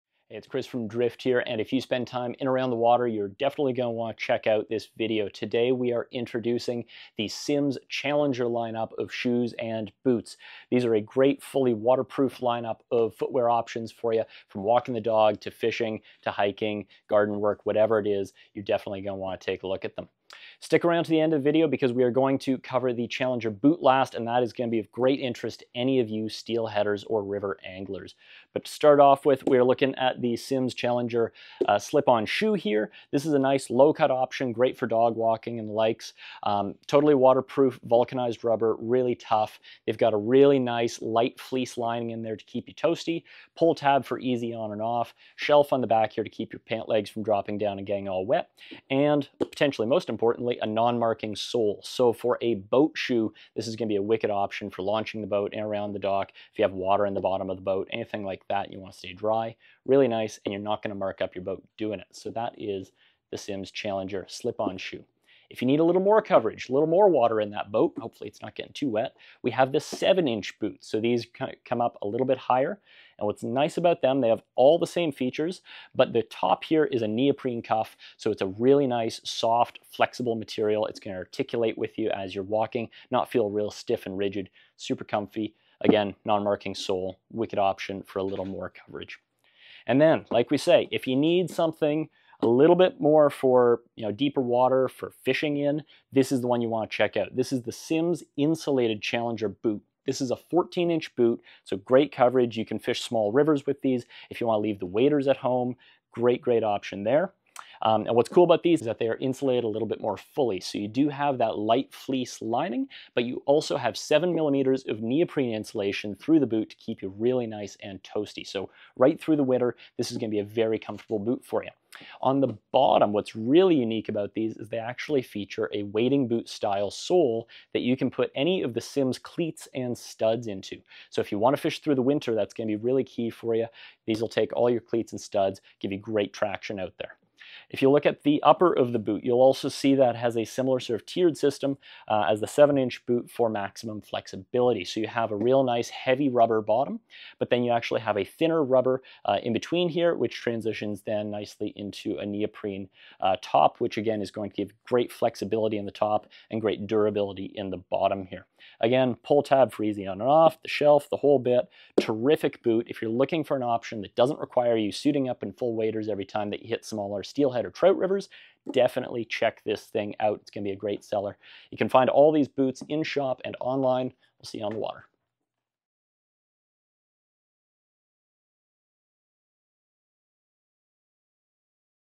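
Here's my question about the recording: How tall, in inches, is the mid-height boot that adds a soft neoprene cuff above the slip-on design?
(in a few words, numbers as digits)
7.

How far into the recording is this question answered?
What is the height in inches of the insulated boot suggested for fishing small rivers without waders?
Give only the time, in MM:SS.
01:40.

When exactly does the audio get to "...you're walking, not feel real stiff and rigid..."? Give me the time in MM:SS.
01:22.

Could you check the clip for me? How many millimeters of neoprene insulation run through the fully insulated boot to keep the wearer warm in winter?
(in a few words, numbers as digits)
7.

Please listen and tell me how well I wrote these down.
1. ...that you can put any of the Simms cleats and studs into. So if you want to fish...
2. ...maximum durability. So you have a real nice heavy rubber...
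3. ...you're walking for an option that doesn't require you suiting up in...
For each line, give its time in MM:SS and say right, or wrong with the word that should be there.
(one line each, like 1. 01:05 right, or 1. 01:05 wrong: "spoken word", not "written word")
1. 02:07 right
2. 02:23 wrong: "flexibility", not "durability"
3. 02:43 wrong: "looking", not "walking".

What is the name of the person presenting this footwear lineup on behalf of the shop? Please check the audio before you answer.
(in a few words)
Chris.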